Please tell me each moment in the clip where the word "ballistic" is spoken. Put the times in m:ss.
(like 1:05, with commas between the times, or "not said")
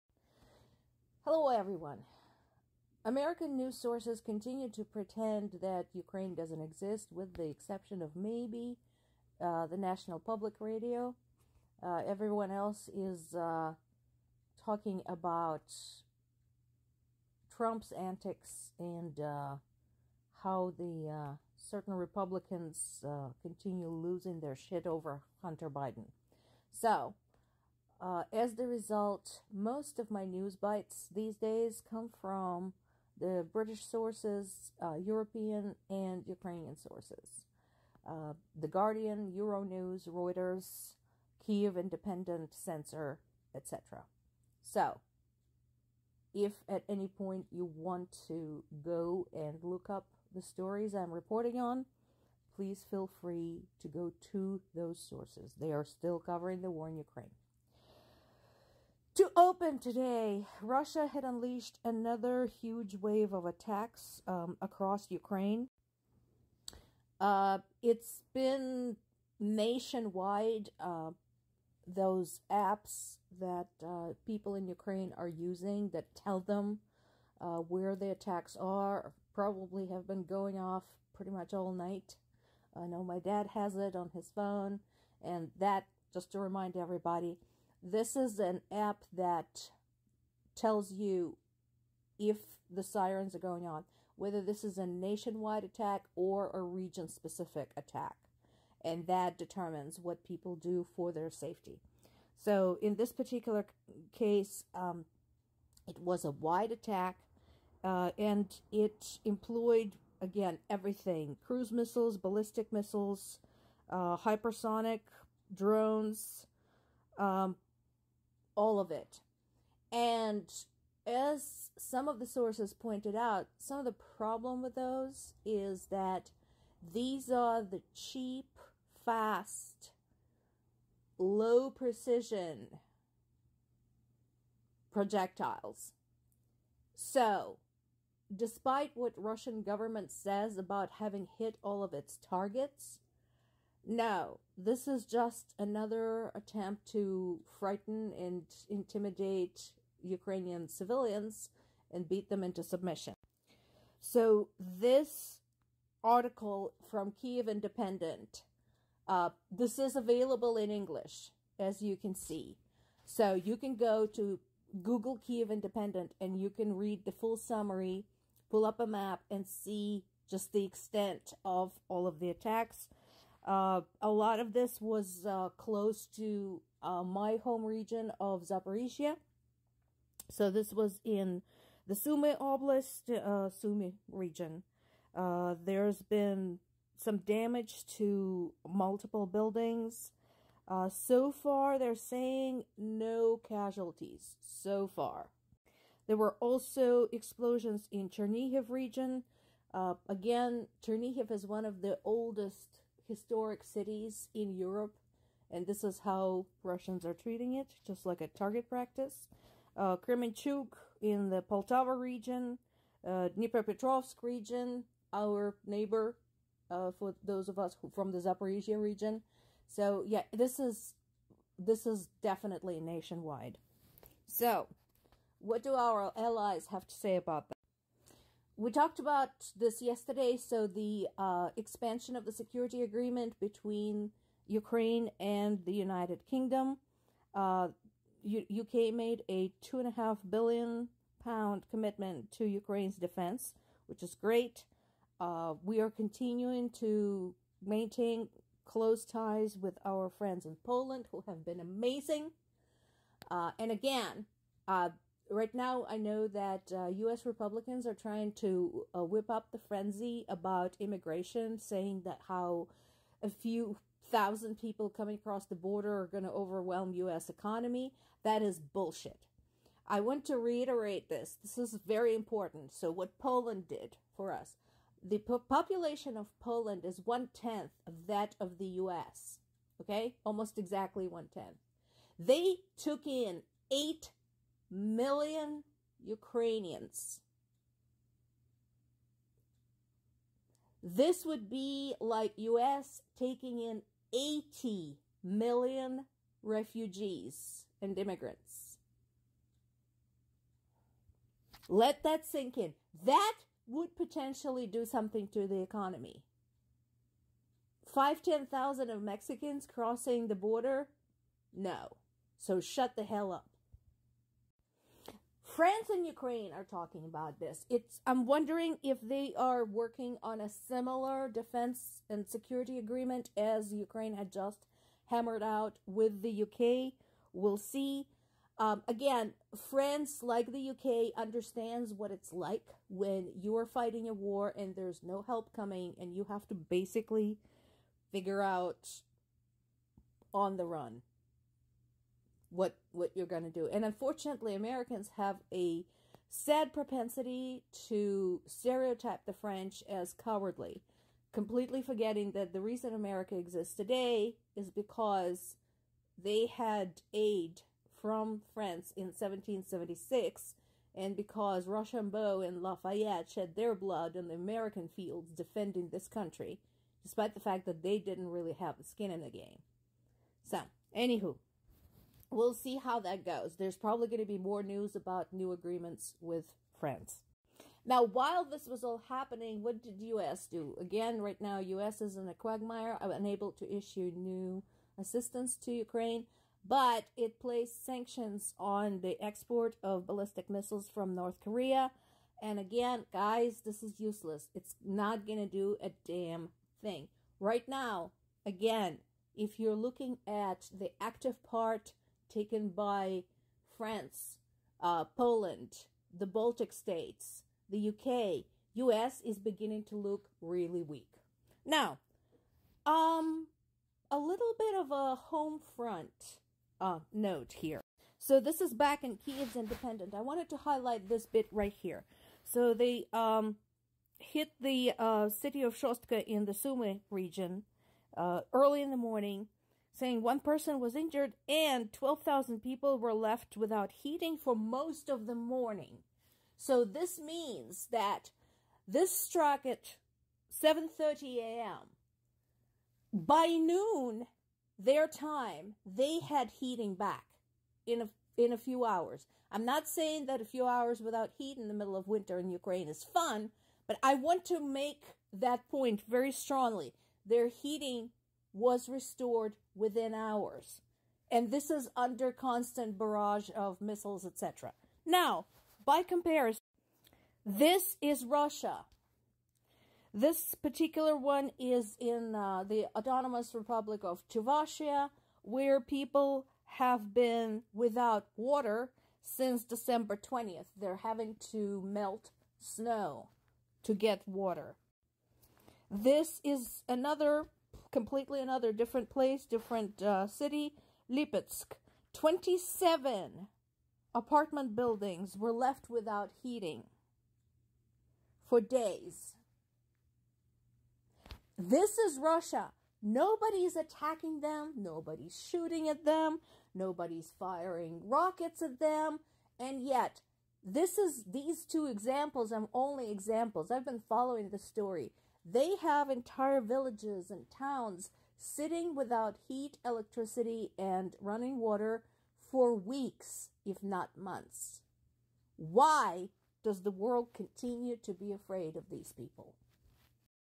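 1:52, 6:30.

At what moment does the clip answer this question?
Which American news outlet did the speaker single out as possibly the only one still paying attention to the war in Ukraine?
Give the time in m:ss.
0:09.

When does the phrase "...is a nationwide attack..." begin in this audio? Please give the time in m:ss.
1:34.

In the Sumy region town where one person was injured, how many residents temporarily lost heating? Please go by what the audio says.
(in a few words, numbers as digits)
12,000.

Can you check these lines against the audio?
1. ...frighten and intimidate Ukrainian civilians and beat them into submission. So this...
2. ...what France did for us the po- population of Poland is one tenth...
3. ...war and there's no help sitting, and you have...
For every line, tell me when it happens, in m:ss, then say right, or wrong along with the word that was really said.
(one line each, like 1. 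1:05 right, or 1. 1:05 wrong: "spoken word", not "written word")
1. 2:27 right
2. 4:32 wrong: "Poland", not "France"
3. 5:34 wrong: "coming", not "sitting".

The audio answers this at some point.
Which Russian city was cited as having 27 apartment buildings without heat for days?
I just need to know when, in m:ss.
8:11.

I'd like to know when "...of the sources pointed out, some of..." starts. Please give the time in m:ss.
2:02.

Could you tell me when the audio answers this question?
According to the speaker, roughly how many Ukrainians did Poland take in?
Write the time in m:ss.
4:43.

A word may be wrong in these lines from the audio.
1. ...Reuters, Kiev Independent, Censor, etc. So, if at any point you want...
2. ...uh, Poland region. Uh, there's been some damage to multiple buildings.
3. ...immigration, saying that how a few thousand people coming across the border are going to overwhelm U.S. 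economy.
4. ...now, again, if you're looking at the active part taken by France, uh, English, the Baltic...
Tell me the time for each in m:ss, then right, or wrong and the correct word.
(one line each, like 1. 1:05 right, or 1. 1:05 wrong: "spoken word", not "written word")
1. 0:40 right
2. 3:03 wrong: "Sumy", not "Poland"
3. 4:20 right
4. 6:37 wrong: "Poland", not "English".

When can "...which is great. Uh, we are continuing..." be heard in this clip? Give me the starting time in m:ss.
4:03.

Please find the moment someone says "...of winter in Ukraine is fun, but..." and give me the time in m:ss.
7:31.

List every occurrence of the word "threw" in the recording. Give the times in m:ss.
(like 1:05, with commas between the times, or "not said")
not said.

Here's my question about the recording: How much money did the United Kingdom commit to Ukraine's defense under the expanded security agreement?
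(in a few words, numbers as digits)
2.5 billion pounds.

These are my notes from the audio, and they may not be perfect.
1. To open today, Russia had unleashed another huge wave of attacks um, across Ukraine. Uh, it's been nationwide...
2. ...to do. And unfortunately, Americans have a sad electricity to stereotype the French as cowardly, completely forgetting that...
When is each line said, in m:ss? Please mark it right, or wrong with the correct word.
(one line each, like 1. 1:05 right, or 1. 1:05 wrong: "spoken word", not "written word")
1. 0:59 right
2. 5:43 wrong: "propensity", not "electricity".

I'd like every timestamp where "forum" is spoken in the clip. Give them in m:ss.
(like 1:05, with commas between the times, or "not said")
not said.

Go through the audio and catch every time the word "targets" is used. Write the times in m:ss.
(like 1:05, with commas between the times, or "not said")
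2:22, 3:28.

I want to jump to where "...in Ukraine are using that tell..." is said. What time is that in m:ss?
1:14.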